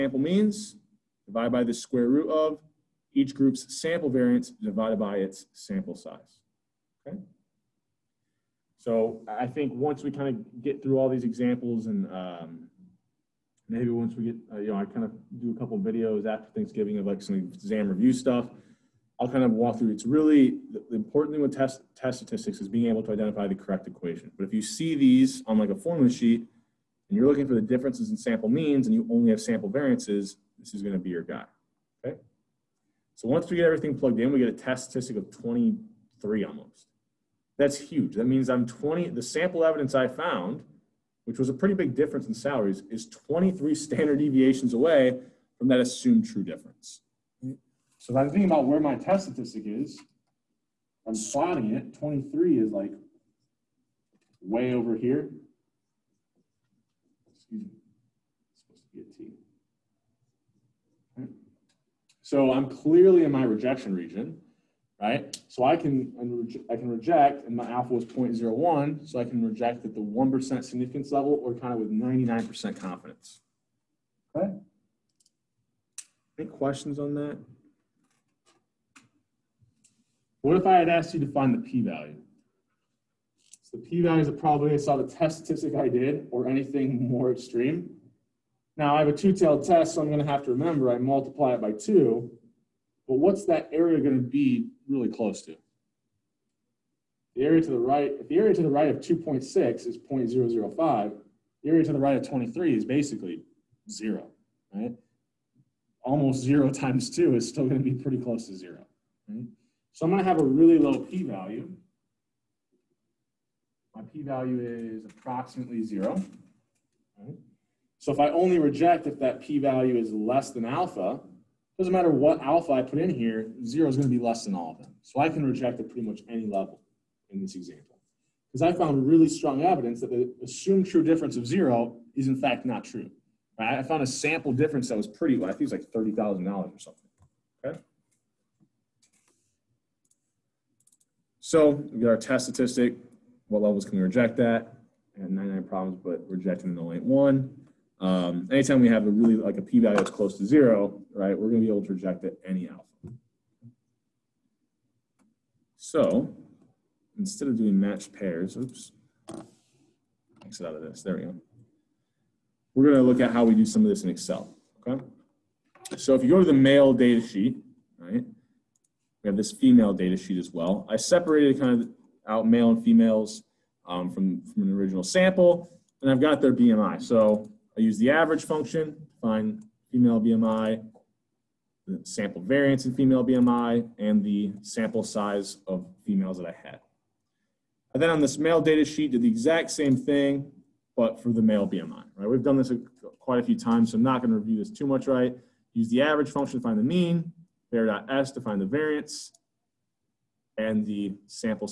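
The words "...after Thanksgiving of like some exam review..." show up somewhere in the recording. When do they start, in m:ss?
0:16.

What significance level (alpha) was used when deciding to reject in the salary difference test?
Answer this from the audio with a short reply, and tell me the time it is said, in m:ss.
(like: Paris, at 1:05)
0.01, at 1:08.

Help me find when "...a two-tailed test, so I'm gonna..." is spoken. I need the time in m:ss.
1:29.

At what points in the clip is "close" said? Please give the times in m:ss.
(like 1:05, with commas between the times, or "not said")
1:35, 1:48, 2:30.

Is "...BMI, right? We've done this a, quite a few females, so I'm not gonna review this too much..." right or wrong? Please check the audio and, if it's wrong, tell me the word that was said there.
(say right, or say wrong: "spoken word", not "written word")
wrong: "times", not "females".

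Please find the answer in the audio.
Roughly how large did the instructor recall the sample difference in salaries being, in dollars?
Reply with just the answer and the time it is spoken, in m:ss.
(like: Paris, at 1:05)
$30,000, at 2:15.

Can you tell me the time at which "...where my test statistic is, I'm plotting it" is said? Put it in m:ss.
0:48.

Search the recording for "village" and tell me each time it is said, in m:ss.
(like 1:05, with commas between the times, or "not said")
not said.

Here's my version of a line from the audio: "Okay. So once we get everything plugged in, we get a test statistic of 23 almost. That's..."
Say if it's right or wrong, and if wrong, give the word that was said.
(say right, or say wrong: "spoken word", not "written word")
right.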